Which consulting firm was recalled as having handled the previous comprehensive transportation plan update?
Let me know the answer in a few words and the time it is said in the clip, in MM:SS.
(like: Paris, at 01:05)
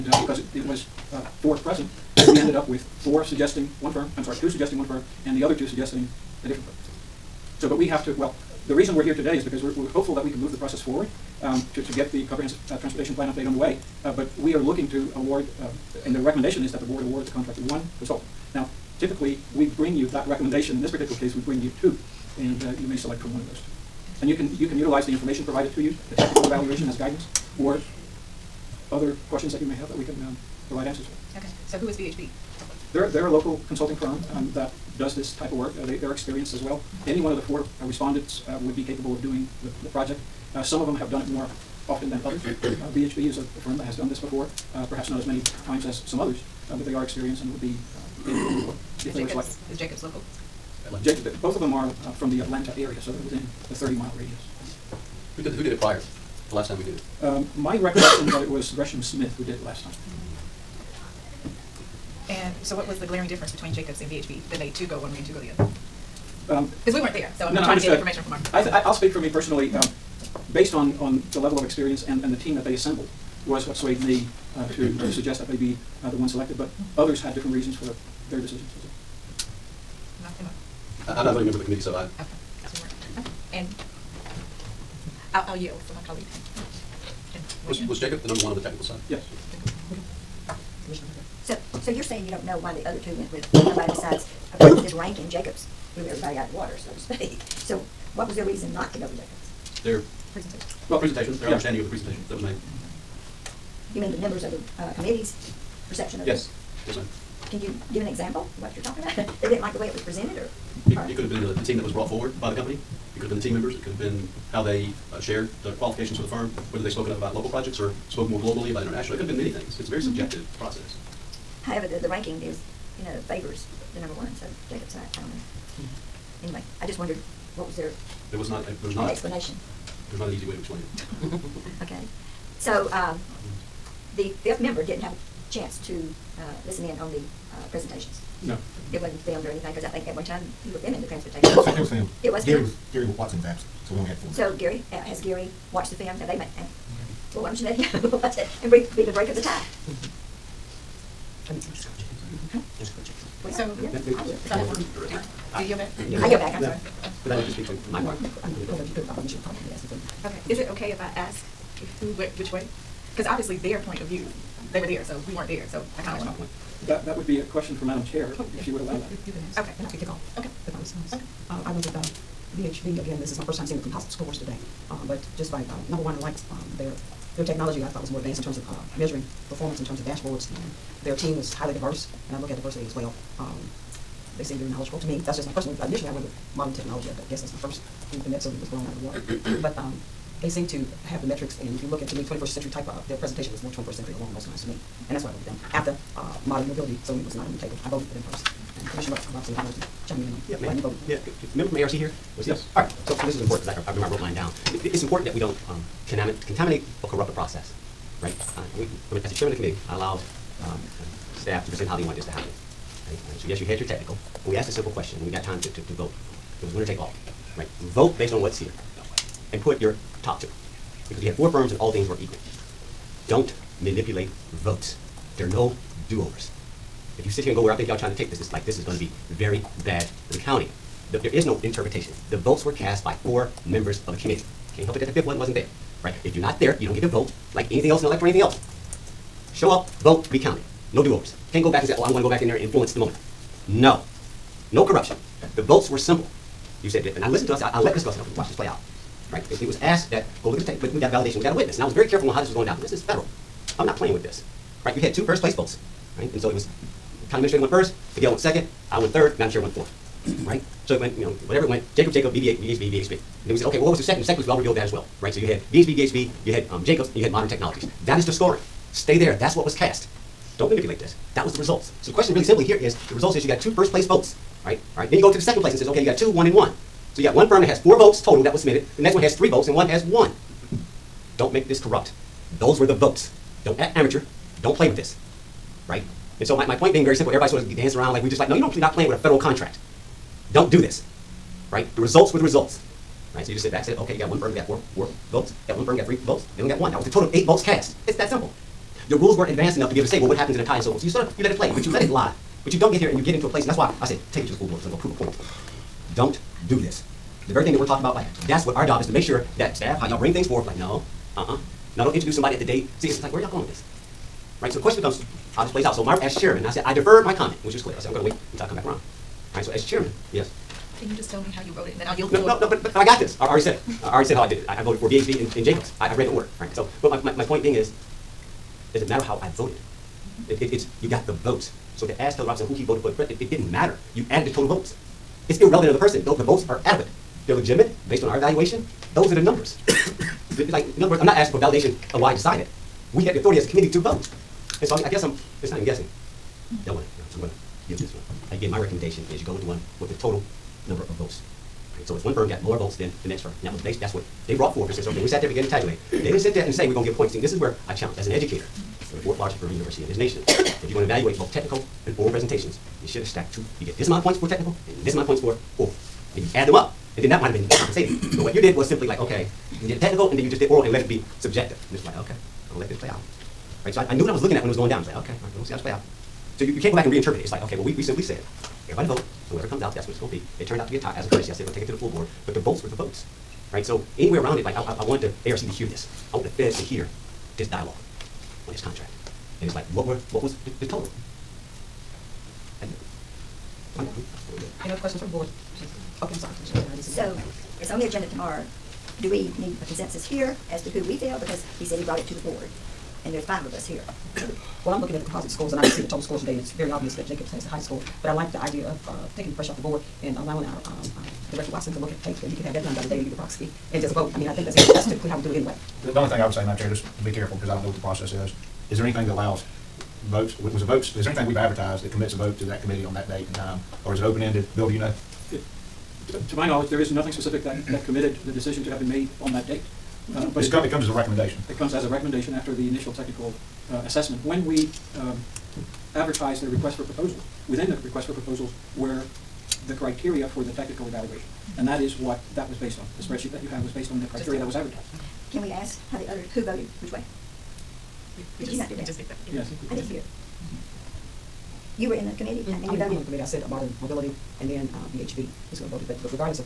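Gresham Smith, at 00:58.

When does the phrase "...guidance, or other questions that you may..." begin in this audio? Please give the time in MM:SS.
00:26.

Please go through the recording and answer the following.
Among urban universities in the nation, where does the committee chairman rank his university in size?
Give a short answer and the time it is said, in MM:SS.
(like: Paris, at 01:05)
fourth largest, at 05:59.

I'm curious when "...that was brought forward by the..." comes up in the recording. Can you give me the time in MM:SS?
01:51.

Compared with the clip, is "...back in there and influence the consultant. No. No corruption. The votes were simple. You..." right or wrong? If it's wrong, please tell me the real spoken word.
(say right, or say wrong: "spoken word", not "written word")
wrong: "moment", not "consultant".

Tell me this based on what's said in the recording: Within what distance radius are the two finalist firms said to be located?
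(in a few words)
30 miles.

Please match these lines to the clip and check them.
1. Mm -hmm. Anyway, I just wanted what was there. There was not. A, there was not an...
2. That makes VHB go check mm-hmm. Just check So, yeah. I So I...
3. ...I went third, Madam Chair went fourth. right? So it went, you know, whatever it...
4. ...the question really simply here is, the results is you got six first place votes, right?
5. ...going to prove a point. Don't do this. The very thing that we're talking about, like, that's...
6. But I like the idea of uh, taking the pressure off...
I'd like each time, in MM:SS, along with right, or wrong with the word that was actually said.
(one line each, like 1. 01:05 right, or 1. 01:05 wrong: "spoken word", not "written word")
1. 02:05 wrong: "wondered", not "wanted"
2. 02:31 wrong: "Just", not "VHB"
3. 04:18 right
4. 04:32 wrong: "two", not "six"
5. 05:04 right
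6. 06:48 right.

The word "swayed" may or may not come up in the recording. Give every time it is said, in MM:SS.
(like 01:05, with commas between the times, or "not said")
01:13.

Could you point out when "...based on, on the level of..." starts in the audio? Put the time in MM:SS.
01:10.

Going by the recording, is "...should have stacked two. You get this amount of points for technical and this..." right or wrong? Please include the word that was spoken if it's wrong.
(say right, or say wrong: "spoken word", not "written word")
right.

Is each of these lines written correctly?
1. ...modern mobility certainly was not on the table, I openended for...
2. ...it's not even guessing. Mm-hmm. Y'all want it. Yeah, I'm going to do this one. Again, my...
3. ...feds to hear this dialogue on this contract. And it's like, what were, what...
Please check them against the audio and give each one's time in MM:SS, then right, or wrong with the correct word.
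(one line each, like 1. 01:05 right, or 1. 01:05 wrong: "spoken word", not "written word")
1. 03:16 wrong: "voted", not "openended"
2. 05:45 right
3. 06:26 right.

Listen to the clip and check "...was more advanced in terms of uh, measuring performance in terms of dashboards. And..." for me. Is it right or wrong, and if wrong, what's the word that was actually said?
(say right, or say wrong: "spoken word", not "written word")
right.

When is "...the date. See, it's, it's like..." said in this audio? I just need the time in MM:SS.
05:12.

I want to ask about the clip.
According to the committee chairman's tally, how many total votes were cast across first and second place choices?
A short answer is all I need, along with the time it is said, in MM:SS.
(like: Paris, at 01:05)
8, at 04:57.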